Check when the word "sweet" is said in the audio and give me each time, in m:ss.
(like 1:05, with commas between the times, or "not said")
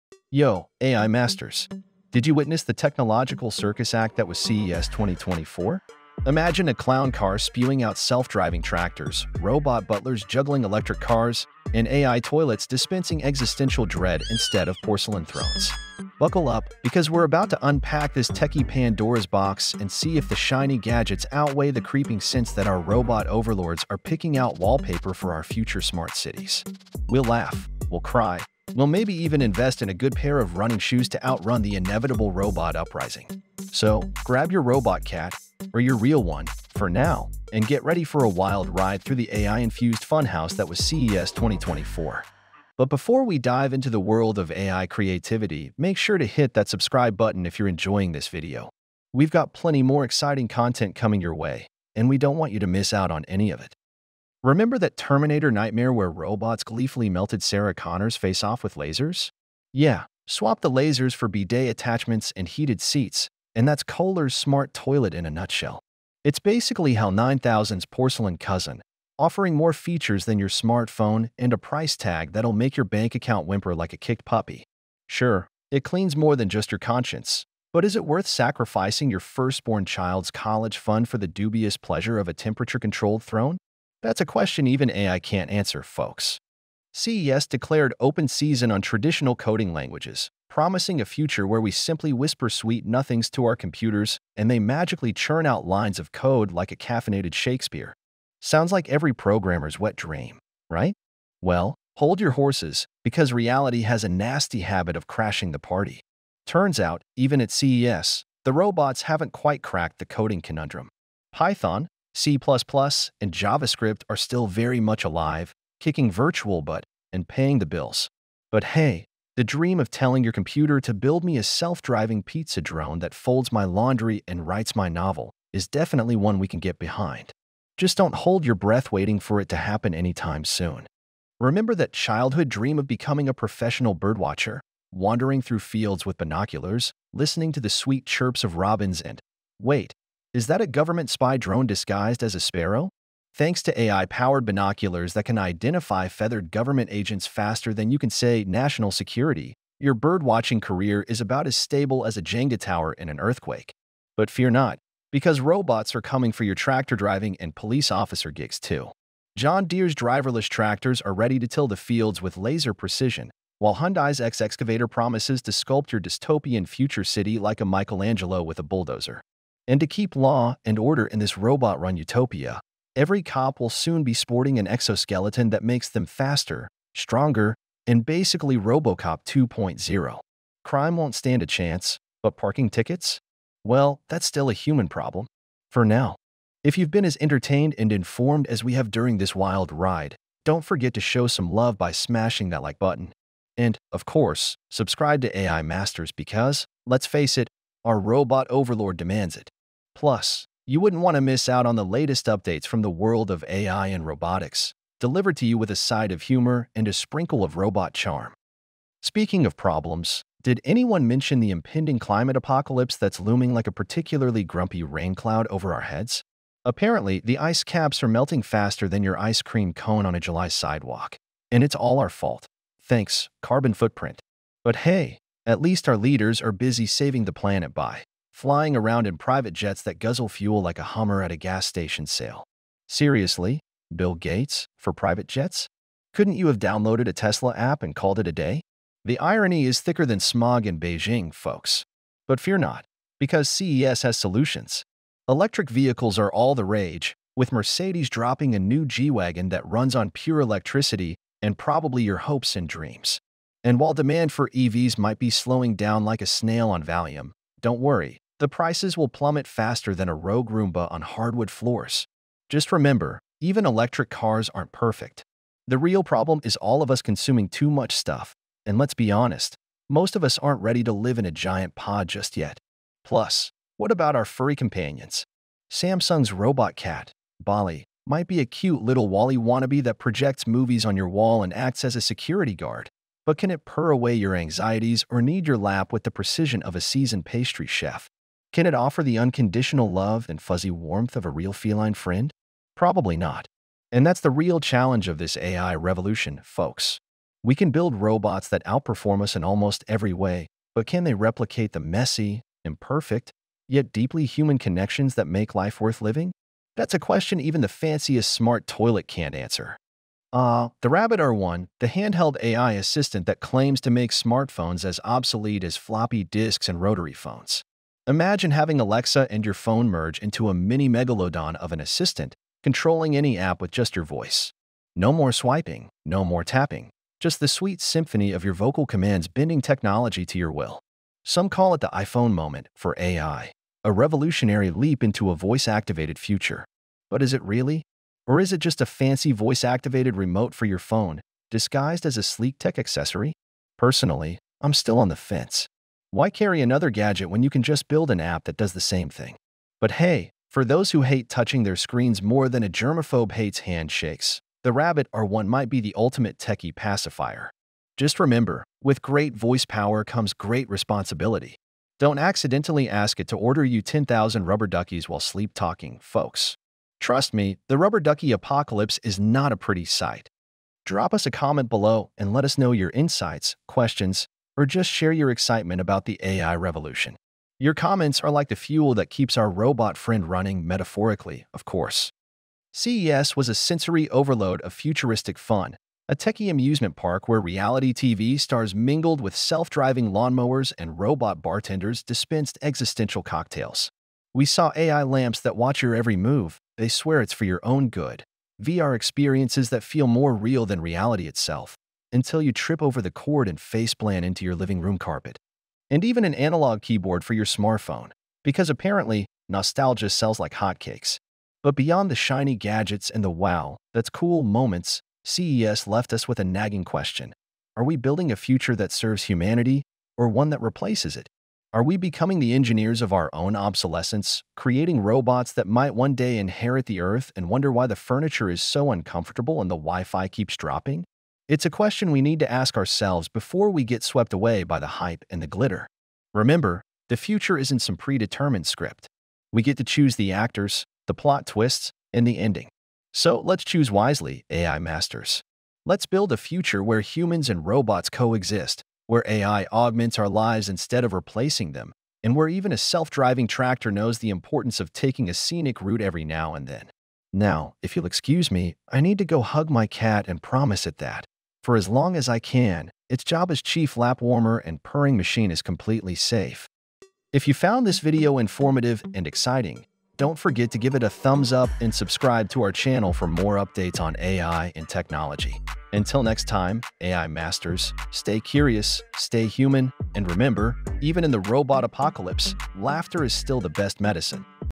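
1:32, 2:17, 5:27.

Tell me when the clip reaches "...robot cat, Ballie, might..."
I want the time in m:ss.
4:36.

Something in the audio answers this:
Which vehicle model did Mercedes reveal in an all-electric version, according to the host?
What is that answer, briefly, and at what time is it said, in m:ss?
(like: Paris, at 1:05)
G-Wagon, at 4:08.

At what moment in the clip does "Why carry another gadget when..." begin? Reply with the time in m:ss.
5:46.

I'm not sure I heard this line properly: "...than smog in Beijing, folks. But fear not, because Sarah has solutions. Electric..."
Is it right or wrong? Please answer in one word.
wrong.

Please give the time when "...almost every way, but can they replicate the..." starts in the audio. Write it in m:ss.
4:59.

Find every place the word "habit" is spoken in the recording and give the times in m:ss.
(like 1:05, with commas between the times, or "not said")
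1:44.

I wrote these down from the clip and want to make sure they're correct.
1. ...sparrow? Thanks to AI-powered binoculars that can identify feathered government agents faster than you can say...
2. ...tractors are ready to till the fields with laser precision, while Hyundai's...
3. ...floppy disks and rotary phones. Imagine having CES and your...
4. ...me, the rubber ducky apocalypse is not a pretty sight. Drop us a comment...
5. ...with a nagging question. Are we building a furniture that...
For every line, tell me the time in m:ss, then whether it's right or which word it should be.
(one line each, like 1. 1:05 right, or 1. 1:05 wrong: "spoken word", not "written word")
1. 2:22 right
2. 2:40 right
3. 5:15 wrong: "Alexa", not "CES"
4. 6:07 right
5. 6:56 wrong: "future", not "furniture".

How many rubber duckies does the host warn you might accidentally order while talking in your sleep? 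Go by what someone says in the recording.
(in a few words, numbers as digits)
10,000.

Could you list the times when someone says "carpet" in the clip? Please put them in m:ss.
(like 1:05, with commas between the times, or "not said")
6:44.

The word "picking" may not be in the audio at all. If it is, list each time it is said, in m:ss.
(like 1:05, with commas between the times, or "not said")
0:23.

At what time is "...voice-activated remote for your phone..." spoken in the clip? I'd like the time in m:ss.
5:39.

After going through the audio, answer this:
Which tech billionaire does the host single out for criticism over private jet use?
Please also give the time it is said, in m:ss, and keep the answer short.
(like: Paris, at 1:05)
Bill Gates, at 3:53.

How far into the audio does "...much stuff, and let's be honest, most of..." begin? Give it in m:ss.
4:27.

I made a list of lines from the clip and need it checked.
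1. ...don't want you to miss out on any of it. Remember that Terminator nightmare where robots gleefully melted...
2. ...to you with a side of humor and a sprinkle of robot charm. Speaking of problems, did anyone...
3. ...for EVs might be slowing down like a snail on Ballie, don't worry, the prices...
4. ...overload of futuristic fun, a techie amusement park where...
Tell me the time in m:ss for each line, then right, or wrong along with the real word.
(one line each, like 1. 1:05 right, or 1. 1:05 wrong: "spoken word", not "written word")
1. 0:52 right
2. 3:25 right
3. 4:14 wrong: "Valium", not "Ballie"
4. 6:24 right.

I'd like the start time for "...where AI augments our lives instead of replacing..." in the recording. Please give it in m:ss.
7:29.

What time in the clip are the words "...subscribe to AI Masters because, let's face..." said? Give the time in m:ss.
3:14.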